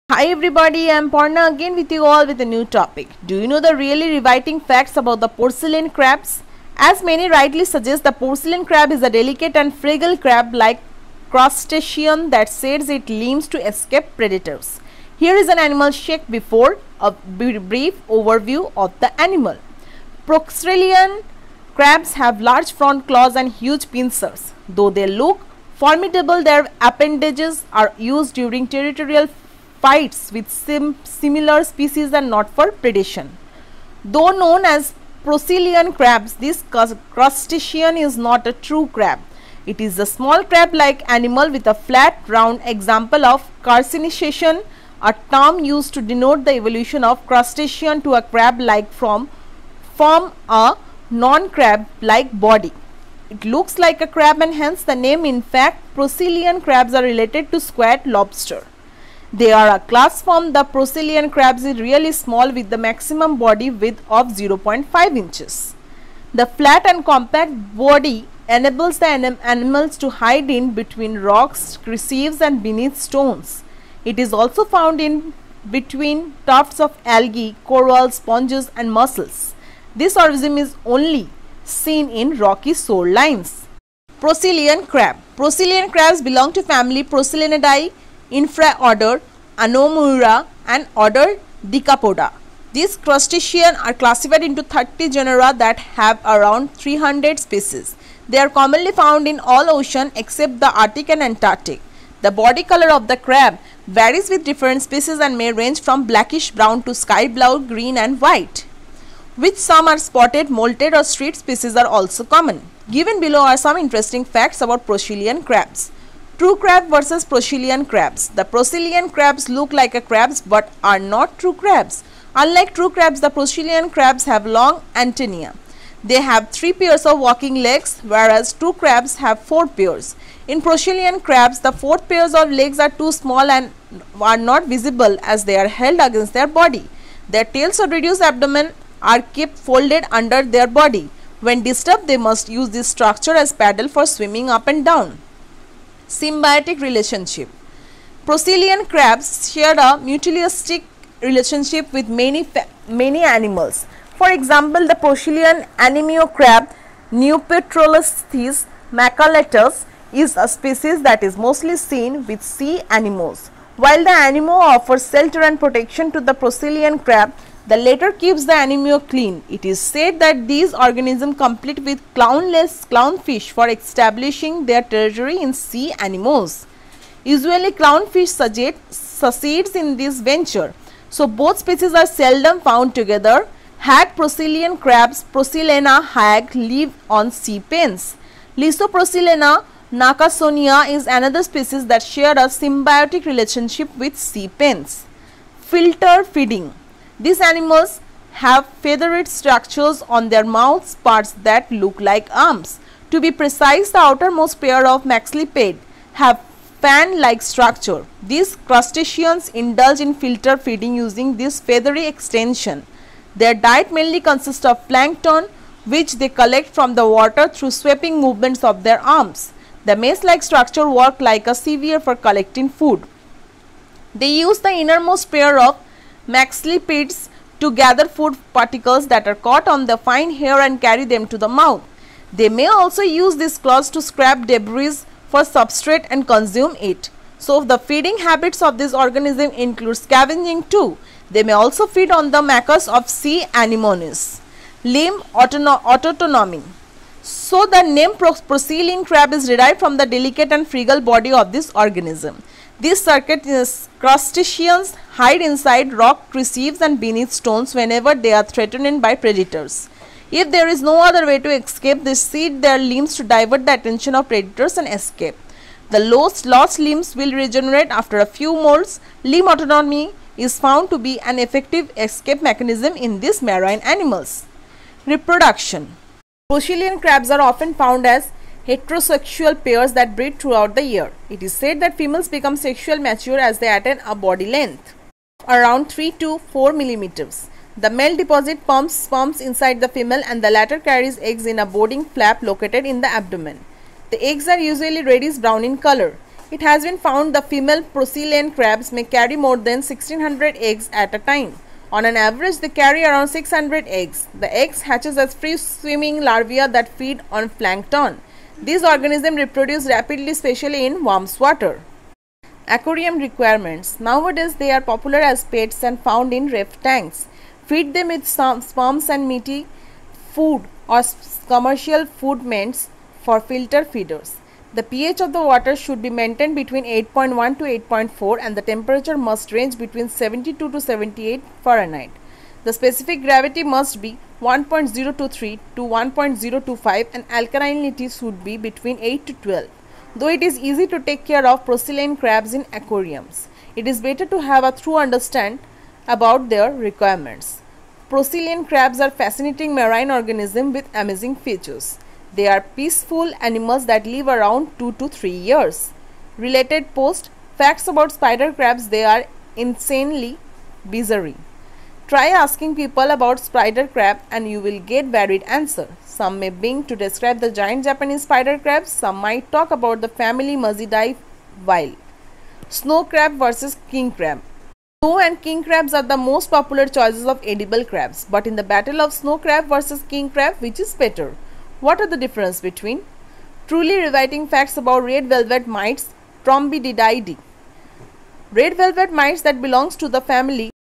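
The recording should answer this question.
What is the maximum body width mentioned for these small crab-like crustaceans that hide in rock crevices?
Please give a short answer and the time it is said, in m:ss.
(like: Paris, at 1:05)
0.5 inches, at 1:04.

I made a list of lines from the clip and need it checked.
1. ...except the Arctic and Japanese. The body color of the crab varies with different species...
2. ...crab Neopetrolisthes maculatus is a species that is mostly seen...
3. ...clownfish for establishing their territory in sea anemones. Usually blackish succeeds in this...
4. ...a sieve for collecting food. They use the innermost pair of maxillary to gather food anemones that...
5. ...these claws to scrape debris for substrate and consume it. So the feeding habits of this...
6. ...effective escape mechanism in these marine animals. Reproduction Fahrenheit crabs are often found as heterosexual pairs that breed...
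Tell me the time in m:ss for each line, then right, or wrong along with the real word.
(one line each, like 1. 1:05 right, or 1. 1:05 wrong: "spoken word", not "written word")
1. 1:40 wrong: "Antarctic", not "Japanese"
2. 2:36 right
3. 2:52 wrong: "clownfish", not "blackish"
4. 3:41 wrong: "particles", not "anemones"
5. 3:53 right
6. 4:31 wrong: "Procellian", not "Fahrenheit".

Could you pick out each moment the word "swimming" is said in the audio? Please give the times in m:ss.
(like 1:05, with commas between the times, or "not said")
2:24, 5:05.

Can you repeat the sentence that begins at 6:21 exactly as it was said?
What are the difference between truly rewriting facts about red velvet mites Trombididae?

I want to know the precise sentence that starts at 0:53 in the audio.
It looks like a crab and hence the name in fact procelian crabs are related to squat lobster.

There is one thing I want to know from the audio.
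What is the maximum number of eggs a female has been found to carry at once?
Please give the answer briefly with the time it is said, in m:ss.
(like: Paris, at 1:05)
1600, at 4:59.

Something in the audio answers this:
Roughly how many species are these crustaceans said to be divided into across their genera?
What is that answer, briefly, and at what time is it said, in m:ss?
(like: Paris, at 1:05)
300, at 1:36.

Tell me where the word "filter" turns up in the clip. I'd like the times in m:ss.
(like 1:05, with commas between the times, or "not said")
3:15, 3:30, 5:23.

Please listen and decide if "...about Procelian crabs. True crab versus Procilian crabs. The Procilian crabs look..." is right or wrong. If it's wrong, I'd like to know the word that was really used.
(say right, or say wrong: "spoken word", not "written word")
right.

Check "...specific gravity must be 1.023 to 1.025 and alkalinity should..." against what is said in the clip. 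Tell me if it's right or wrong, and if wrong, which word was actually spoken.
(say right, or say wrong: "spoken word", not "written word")
right.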